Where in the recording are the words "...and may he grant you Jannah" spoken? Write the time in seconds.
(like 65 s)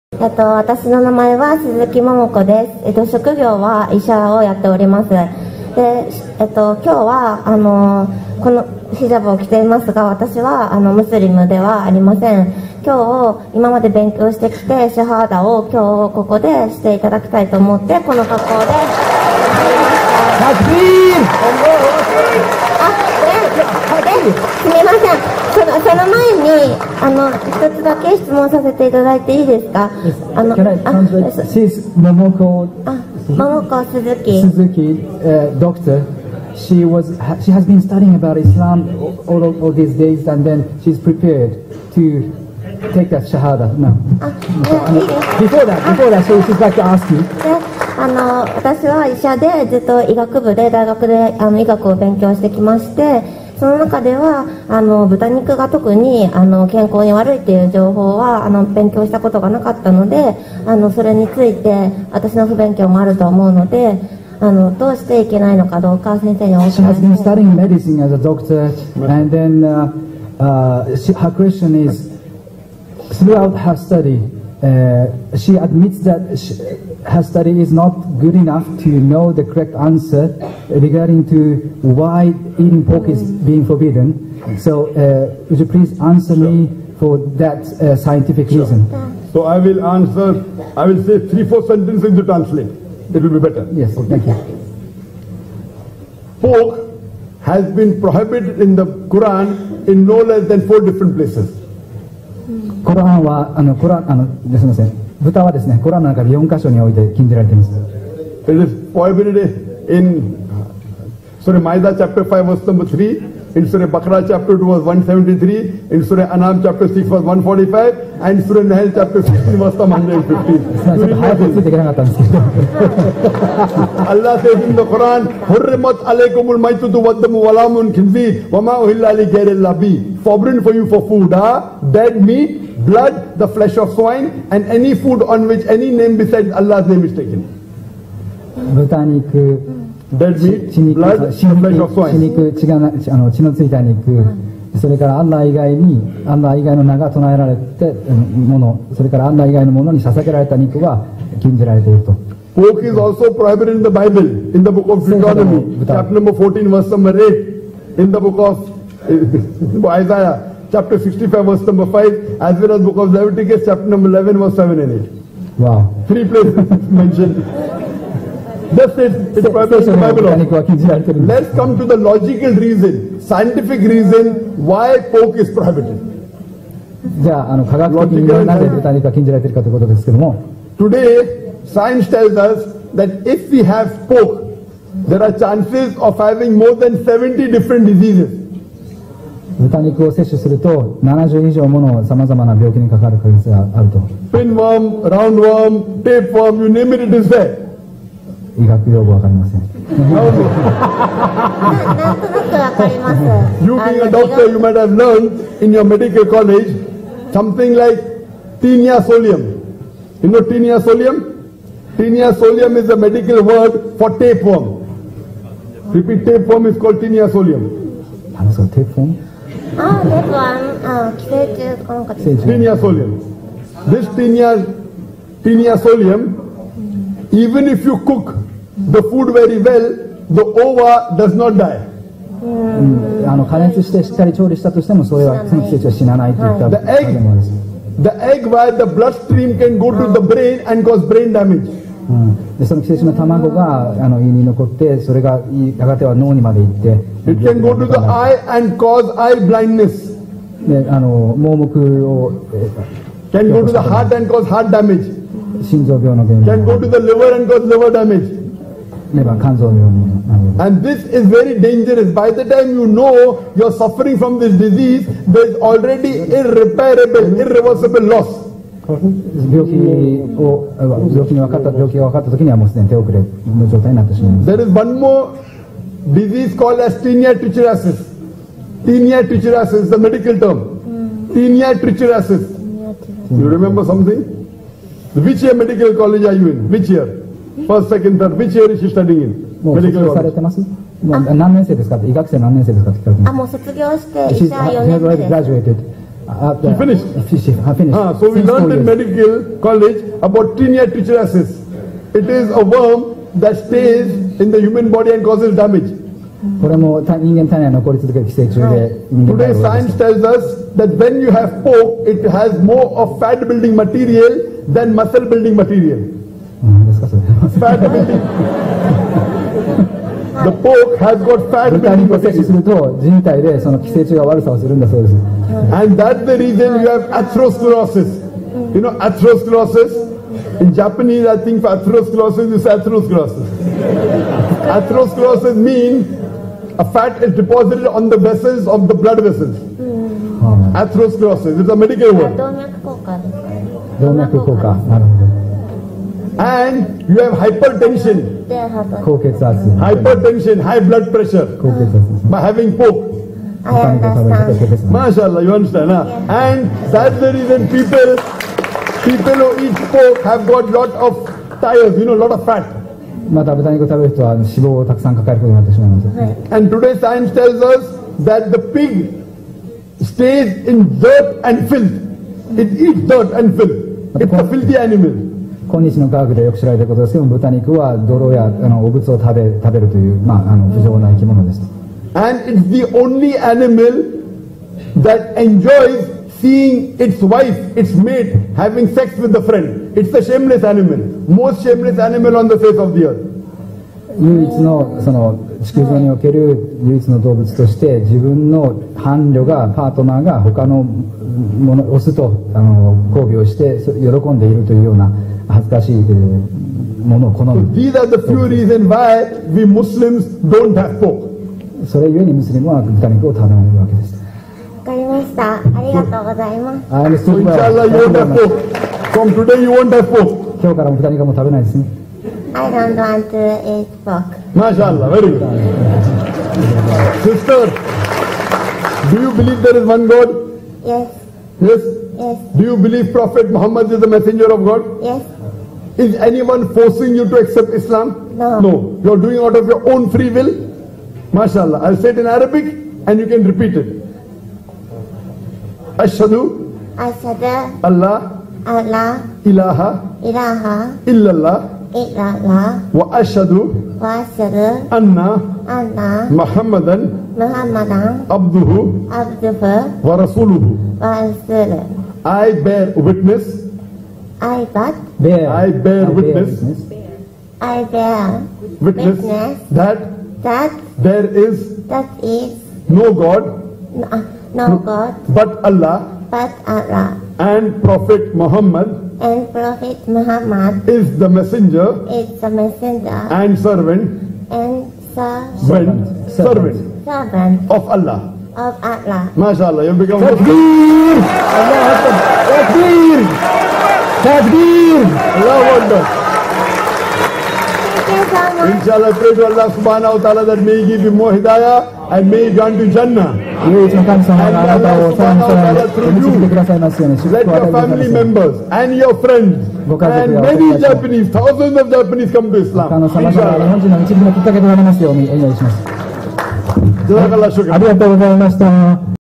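502 s.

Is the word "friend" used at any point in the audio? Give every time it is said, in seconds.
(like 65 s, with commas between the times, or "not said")
389 s, 509 s.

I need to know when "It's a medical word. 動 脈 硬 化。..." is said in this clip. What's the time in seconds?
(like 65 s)
341 s.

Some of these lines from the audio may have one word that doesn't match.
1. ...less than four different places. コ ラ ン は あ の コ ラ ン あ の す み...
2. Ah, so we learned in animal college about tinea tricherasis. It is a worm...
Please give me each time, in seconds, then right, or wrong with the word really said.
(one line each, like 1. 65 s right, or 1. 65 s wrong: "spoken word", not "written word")
1. 100 s right
2. 297 s wrong: "medical", not "animal".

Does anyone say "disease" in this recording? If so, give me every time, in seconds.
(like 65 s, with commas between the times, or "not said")
187 s, 264 s, 276 s.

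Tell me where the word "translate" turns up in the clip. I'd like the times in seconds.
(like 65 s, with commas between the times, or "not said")
30 s, 92 s.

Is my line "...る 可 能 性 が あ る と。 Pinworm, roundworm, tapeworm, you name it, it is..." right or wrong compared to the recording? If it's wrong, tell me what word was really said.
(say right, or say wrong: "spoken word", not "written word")
right.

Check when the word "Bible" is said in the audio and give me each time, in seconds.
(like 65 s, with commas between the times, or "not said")
153 s, 169 s.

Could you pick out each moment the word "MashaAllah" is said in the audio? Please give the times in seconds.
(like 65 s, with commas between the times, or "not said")
354 s, 424 s, 441 s, 489 s.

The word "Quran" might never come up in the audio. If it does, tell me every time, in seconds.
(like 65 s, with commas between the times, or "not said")
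98 s, 124 s.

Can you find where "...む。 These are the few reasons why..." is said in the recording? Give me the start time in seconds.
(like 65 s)
407 s.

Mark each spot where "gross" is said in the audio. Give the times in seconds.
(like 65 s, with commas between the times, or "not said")
not said.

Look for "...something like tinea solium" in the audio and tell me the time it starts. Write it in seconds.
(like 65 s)
207 s.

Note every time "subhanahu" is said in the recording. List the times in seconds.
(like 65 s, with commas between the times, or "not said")
499 s, 505 s.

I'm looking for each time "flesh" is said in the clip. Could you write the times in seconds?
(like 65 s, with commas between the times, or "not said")
133 s, 141 s.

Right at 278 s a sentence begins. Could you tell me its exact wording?
Tinea trichuriasis is the medical term.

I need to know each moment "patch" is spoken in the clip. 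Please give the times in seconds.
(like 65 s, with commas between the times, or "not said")
not said.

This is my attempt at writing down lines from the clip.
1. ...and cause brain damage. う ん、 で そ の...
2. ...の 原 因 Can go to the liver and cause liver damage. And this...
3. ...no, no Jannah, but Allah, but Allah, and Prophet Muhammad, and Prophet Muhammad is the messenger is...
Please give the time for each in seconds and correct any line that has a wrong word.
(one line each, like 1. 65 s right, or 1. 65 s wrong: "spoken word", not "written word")
1. 240 s right
2. 256 s right
3. 473 s wrong: "God", not "Jannah".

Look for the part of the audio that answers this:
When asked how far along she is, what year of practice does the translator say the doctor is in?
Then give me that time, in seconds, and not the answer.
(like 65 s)
294 s.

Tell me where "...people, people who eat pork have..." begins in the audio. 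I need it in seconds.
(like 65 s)
357 s.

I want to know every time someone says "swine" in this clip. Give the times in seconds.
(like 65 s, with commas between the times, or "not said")
133 s, 141 s.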